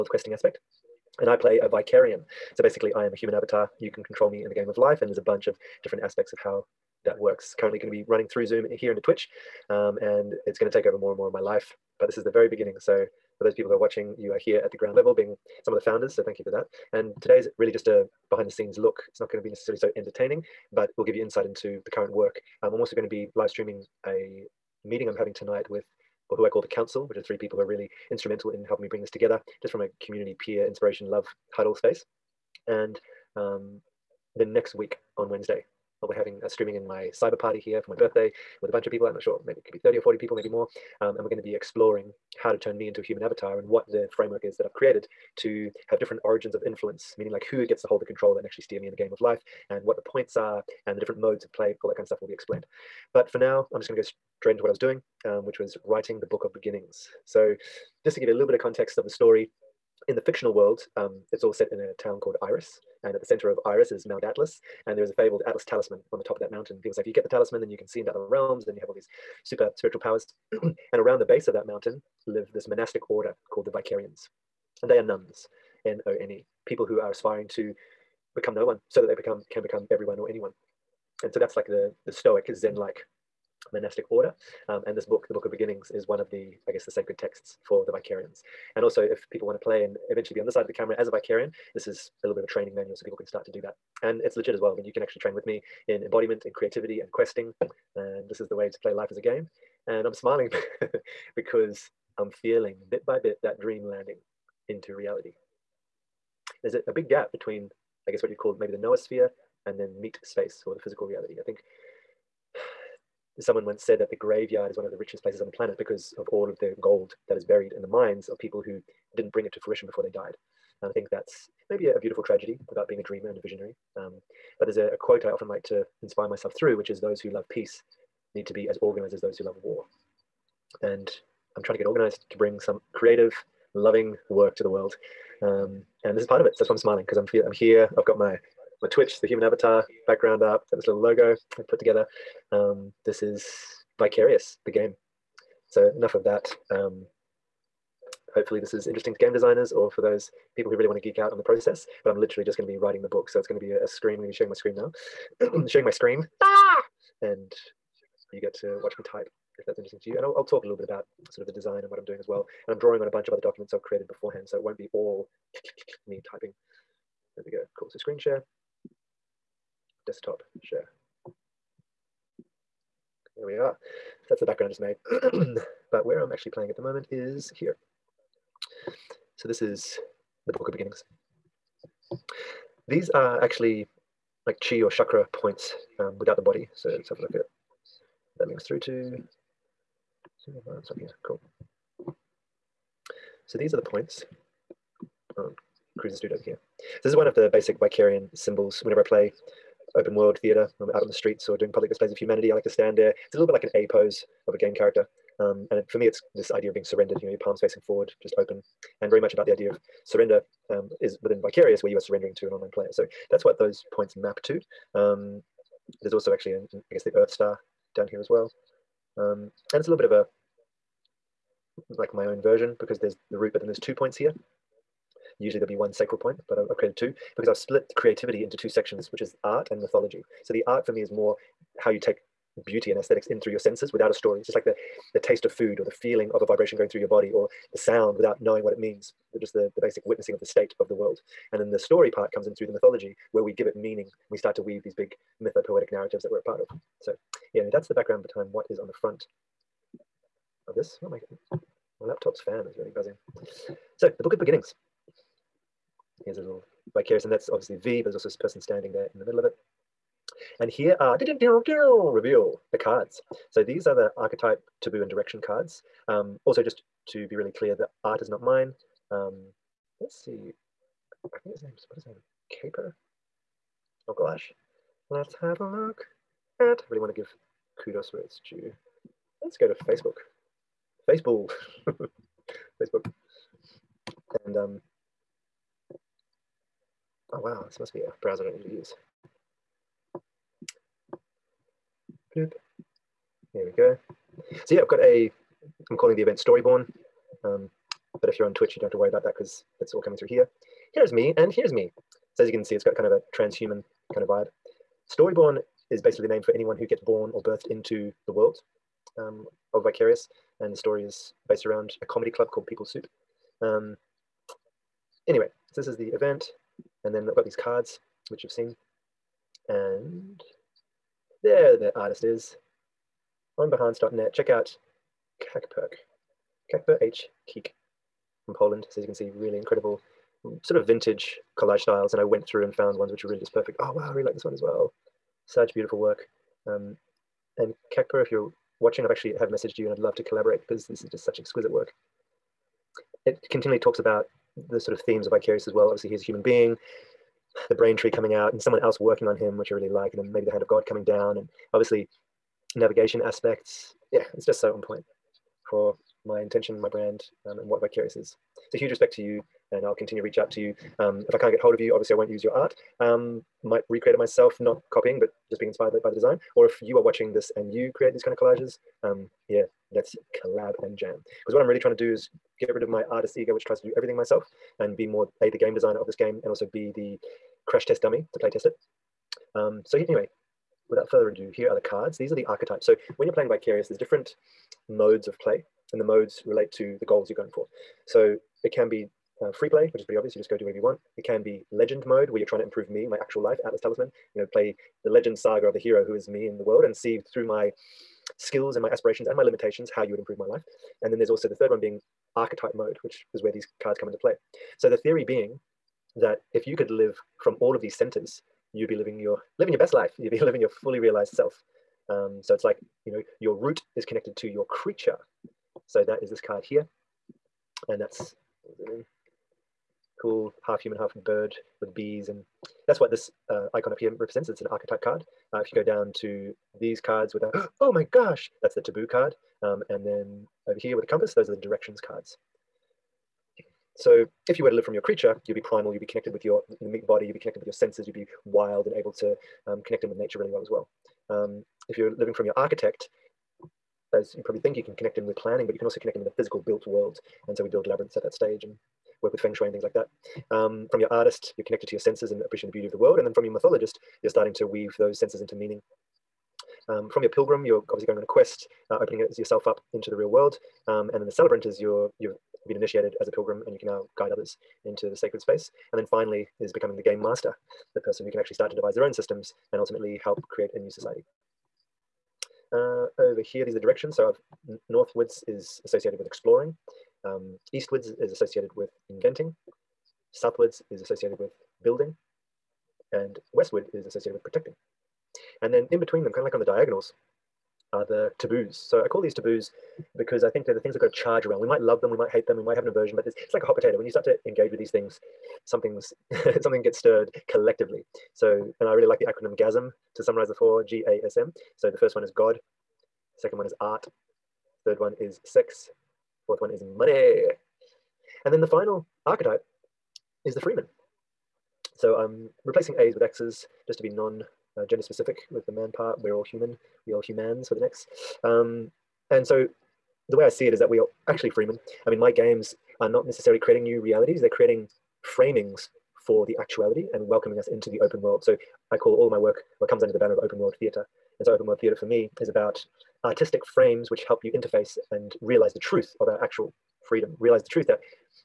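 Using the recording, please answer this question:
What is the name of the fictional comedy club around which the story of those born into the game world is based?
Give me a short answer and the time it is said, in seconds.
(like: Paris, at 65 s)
People's Soup, at 312 s.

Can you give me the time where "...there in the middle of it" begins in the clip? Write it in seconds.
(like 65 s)
258 s.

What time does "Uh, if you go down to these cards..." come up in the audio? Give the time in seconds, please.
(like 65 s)
425 s.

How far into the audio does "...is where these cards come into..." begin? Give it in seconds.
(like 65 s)
403 s.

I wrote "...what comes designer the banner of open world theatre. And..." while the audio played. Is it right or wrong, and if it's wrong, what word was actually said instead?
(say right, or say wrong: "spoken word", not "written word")
wrong: "under", not "designer".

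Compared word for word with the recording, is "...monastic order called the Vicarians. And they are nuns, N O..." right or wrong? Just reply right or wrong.
right.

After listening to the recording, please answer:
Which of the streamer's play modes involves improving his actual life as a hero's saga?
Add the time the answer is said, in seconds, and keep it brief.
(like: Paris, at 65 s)
legend mode, at 391 s.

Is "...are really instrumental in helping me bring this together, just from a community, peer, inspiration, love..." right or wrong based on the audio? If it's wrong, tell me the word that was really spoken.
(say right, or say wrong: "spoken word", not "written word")
right.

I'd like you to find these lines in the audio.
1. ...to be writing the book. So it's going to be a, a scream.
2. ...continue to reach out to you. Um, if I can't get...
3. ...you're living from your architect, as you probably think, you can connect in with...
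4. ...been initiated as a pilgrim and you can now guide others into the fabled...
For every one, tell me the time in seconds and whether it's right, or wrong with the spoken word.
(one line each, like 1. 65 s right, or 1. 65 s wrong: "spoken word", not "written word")
1. 152 s right
2. 359 s right
3. 441 s right
4. 462 s wrong: "sacred", not "fabled".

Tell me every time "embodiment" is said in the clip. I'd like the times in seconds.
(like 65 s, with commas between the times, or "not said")
96 s.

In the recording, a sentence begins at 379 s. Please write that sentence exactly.
Um, so anyway, without further ado, here are the cards.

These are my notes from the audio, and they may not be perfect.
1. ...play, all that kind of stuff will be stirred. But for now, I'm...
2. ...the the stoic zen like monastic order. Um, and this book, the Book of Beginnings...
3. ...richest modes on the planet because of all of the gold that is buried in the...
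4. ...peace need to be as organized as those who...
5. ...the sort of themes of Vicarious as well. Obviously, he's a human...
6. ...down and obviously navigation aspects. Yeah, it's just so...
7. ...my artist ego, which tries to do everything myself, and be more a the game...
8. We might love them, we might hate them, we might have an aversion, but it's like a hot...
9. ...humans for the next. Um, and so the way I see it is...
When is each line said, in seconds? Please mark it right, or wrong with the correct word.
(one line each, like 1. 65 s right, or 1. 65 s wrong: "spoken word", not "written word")
1. 51 s wrong: "explained", not "stirred"
2. 81 s right
3. 114 s wrong: "places", not "modes"
4. 127 s right
5. 344 s right
6. 351 s right
7. 372 s right
8. 491 s right
9. 517 s right.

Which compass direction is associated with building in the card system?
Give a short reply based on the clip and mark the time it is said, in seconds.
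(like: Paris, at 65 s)
Southwards, at 480 s.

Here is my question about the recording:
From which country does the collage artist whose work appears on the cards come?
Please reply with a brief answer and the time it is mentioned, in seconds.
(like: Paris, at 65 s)
Poland, at 328 s.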